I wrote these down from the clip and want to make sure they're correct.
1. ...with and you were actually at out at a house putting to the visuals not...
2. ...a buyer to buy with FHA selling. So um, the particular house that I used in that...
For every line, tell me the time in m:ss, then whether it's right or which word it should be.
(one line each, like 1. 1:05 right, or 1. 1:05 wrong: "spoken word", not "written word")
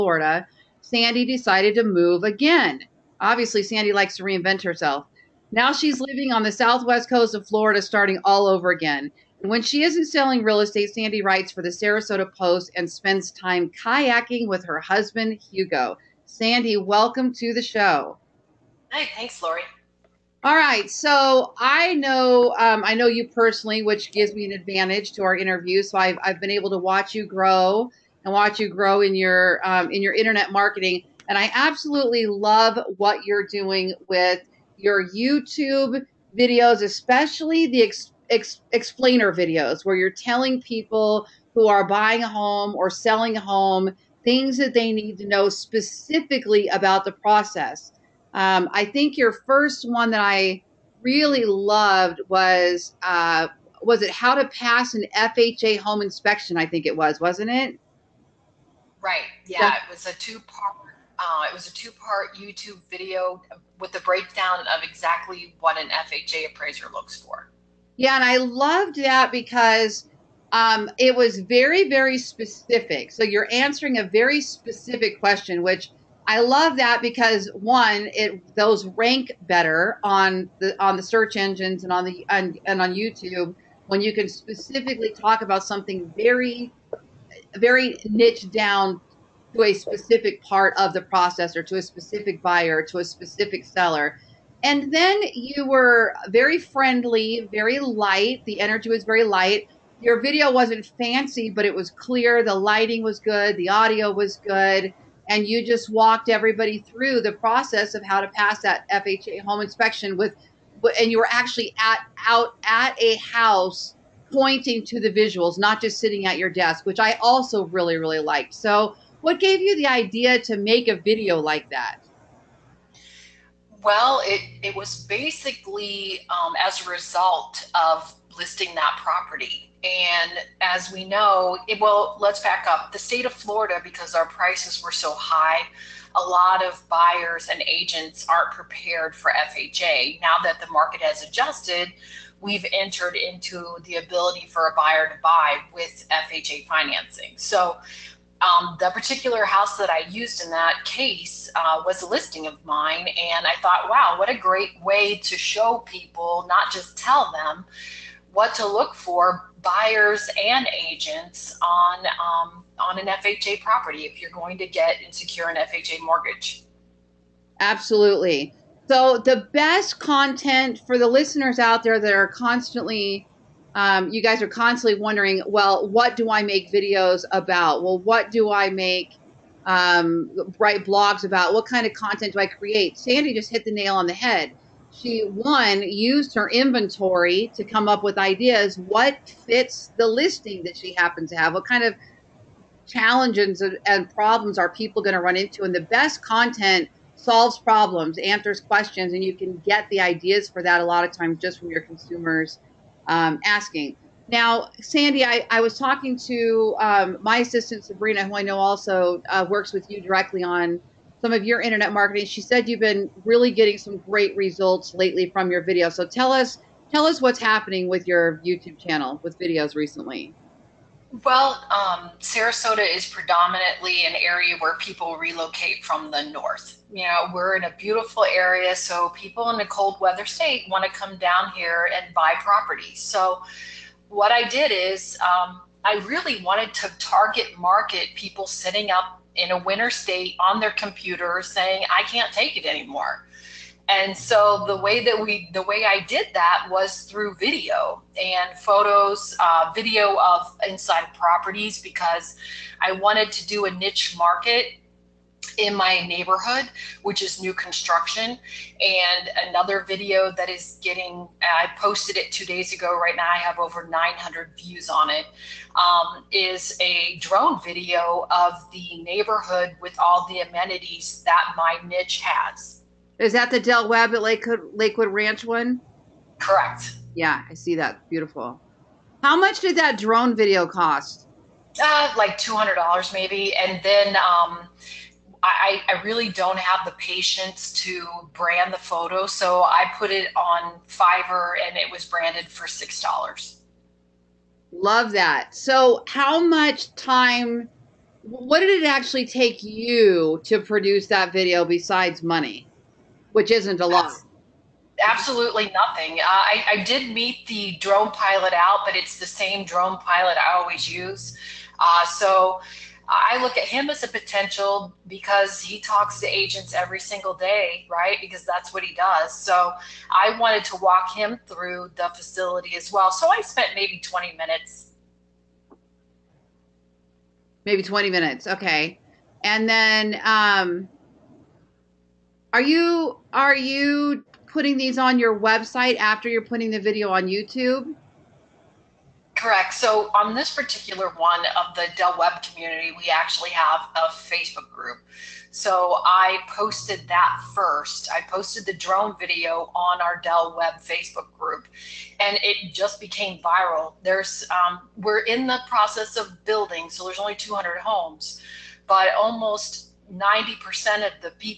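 1. 1:50 wrong: "pointing", not "putting"
2. 2:24 wrong: "financing", not "selling".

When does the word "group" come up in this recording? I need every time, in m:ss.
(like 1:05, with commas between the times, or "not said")
5:44, 5:51.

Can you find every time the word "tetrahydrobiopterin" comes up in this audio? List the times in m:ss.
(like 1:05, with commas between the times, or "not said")
not said.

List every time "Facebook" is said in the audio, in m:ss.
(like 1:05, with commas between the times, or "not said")
5:44, 5:50.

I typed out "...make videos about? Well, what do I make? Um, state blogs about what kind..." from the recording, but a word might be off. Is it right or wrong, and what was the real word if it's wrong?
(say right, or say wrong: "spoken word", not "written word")
wrong: "write", not "state".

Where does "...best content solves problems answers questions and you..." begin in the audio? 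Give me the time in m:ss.
3:15.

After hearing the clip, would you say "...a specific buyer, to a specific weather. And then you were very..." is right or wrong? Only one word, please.
wrong.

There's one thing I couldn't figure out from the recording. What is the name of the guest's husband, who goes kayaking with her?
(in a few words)
Hugo.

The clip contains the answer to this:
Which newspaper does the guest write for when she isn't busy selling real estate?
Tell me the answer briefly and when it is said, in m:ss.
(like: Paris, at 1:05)
Sarasota Post, at 0:11.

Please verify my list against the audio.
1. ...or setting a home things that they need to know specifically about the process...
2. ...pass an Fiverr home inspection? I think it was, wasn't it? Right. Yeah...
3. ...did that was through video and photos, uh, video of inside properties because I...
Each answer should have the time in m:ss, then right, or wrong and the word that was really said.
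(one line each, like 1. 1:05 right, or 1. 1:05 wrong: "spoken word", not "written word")
1. 0:42 wrong: "selling", not "setting"
2. 0:54 wrong: "FHA", not "Fiverr"
3. 4:06 right.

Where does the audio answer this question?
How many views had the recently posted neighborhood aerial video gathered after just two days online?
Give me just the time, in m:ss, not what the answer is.
4:23.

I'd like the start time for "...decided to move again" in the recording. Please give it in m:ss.
0:01.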